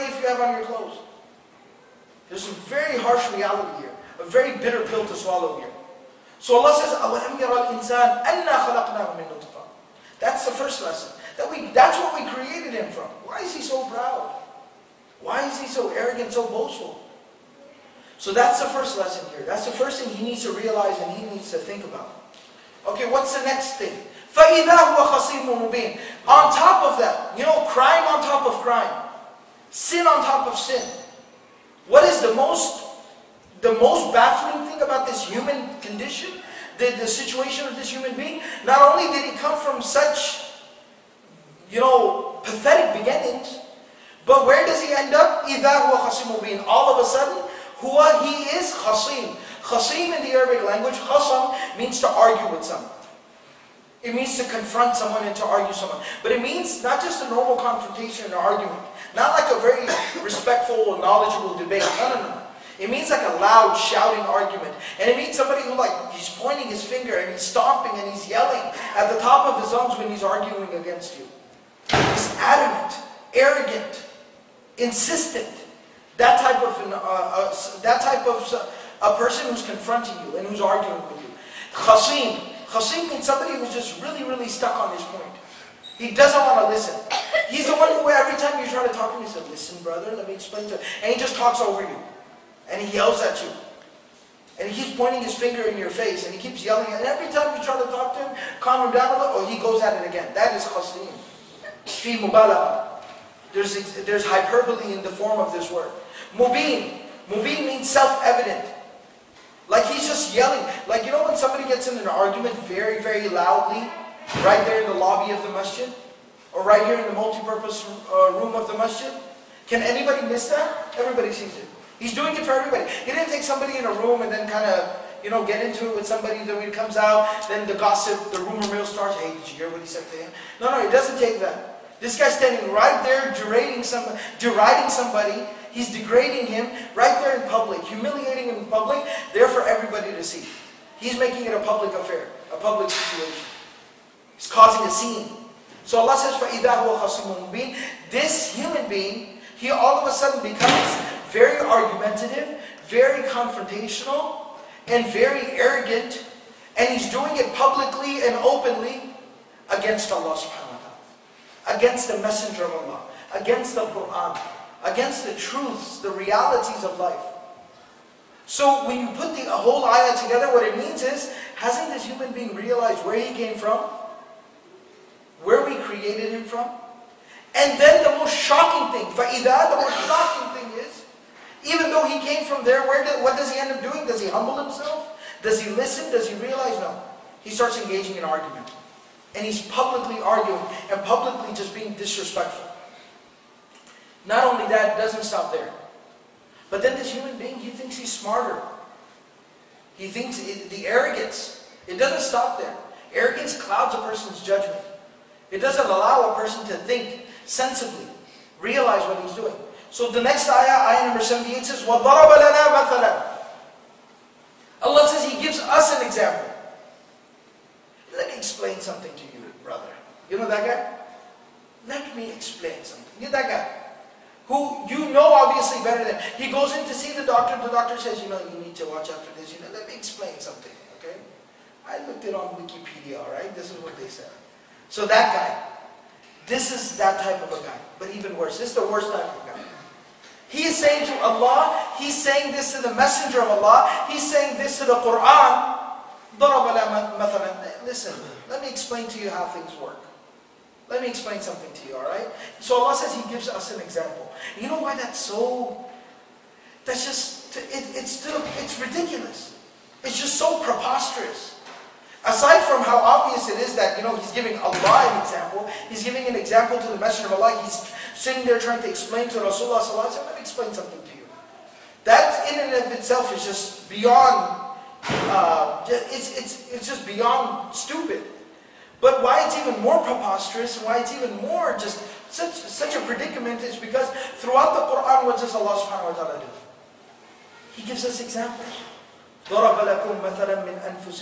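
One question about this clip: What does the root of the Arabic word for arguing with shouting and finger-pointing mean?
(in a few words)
To argue with someone.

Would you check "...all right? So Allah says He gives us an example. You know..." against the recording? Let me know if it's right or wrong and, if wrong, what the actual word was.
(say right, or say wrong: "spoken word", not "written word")
right.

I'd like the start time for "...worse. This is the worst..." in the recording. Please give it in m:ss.
3:58.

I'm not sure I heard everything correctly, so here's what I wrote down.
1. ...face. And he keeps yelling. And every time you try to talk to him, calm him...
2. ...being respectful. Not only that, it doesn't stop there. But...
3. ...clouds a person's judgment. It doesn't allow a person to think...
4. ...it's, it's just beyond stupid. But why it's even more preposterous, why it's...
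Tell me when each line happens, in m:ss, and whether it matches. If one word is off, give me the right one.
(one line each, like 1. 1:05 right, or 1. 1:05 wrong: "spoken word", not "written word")
1. 1:35 right
2. 3:11 wrong: "disrespectful", not "respectful"
3. 3:23 right
4. 4:36 right.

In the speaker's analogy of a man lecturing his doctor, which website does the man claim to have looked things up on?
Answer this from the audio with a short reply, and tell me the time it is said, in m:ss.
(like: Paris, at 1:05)
Wikipedia, at 3:52.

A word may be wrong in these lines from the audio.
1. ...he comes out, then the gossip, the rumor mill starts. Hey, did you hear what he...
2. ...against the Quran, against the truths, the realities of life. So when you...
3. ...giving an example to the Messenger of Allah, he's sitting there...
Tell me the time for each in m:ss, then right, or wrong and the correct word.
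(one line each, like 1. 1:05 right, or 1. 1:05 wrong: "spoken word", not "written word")
1. 2:06 right
2. 2:43 right
3. 4:26 right.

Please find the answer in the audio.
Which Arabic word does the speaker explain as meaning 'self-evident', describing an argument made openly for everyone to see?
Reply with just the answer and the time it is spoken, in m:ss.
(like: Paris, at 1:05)
Mubin, at 1:47.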